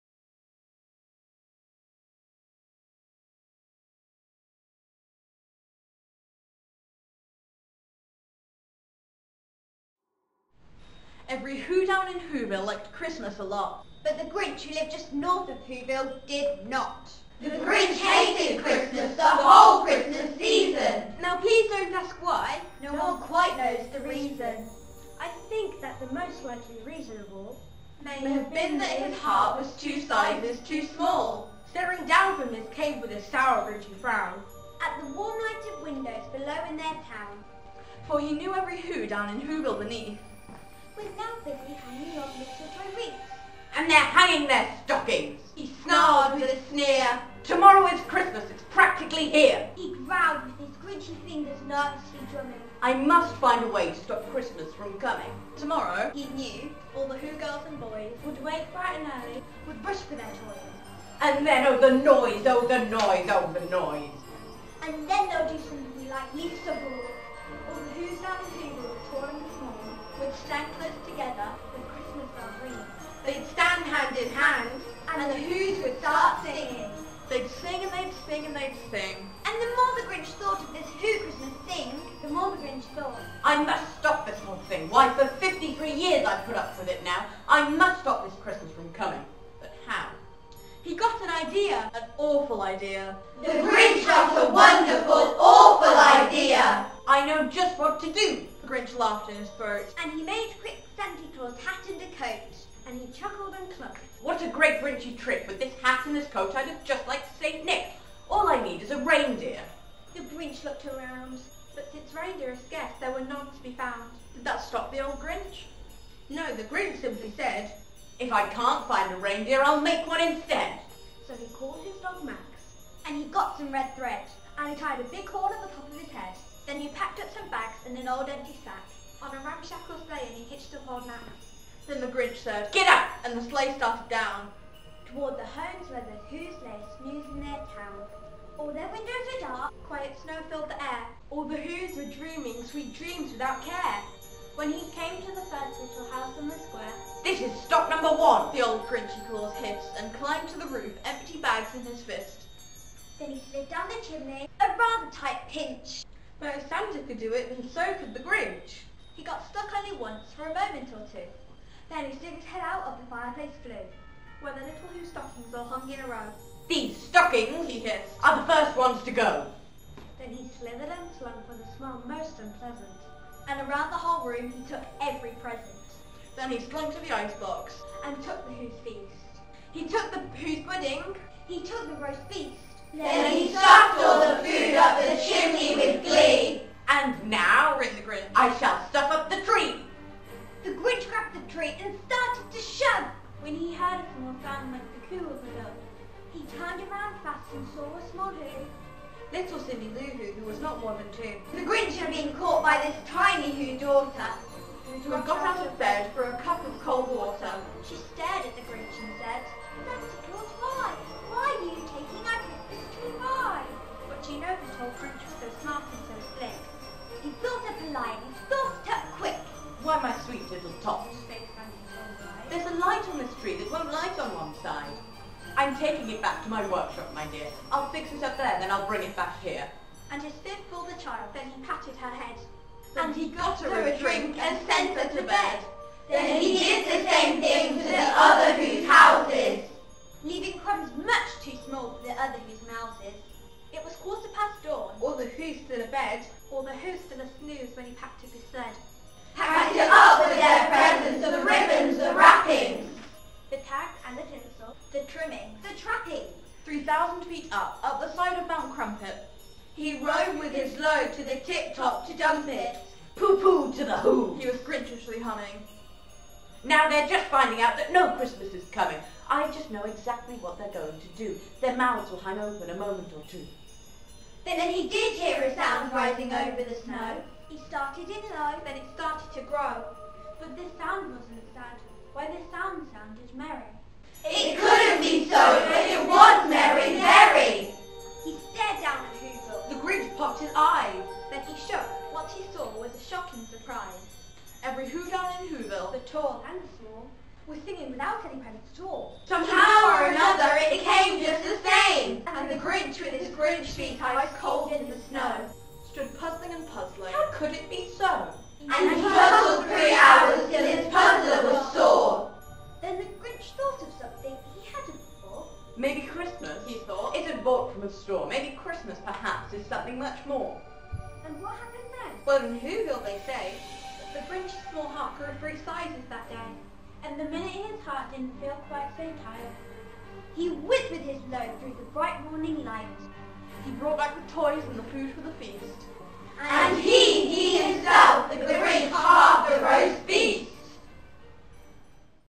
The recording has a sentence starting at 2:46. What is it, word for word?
These stockings, he hissed, are the first ones to go.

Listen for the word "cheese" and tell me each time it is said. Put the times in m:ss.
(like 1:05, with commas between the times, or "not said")
not said.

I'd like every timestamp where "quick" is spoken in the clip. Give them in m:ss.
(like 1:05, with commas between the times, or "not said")
1:40, 3:39.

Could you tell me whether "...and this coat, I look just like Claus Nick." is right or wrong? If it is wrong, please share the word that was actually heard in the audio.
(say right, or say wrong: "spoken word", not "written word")
wrong: "Saint", not "Claus".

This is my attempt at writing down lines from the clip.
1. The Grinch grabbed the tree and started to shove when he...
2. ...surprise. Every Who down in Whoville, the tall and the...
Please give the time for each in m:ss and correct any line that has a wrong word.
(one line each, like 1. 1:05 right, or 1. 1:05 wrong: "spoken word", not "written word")
1. 3:10 right
2. 4:53 right.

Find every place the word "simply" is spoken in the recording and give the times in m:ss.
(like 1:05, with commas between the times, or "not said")
1:57.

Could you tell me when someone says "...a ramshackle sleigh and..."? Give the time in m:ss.
2:09.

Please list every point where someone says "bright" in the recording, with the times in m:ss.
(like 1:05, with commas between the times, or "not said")
0:58, 5:31.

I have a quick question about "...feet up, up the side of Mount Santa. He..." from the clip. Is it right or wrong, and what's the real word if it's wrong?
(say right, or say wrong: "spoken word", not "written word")
wrong: "Crumpet", not "Santa".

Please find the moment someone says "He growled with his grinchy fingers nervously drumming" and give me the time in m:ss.
0:49.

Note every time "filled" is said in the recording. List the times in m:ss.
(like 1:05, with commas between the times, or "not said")
2:20.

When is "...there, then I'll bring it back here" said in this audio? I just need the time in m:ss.
3:48.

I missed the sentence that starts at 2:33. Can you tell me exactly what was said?
Then he slid down the chimney, a rather tight pinch.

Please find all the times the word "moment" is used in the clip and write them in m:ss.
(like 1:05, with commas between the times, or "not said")
2:40, 4:32.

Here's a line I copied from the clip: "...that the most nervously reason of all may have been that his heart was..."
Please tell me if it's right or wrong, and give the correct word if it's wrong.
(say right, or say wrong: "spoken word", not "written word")
wrong: "likely", not "nervously".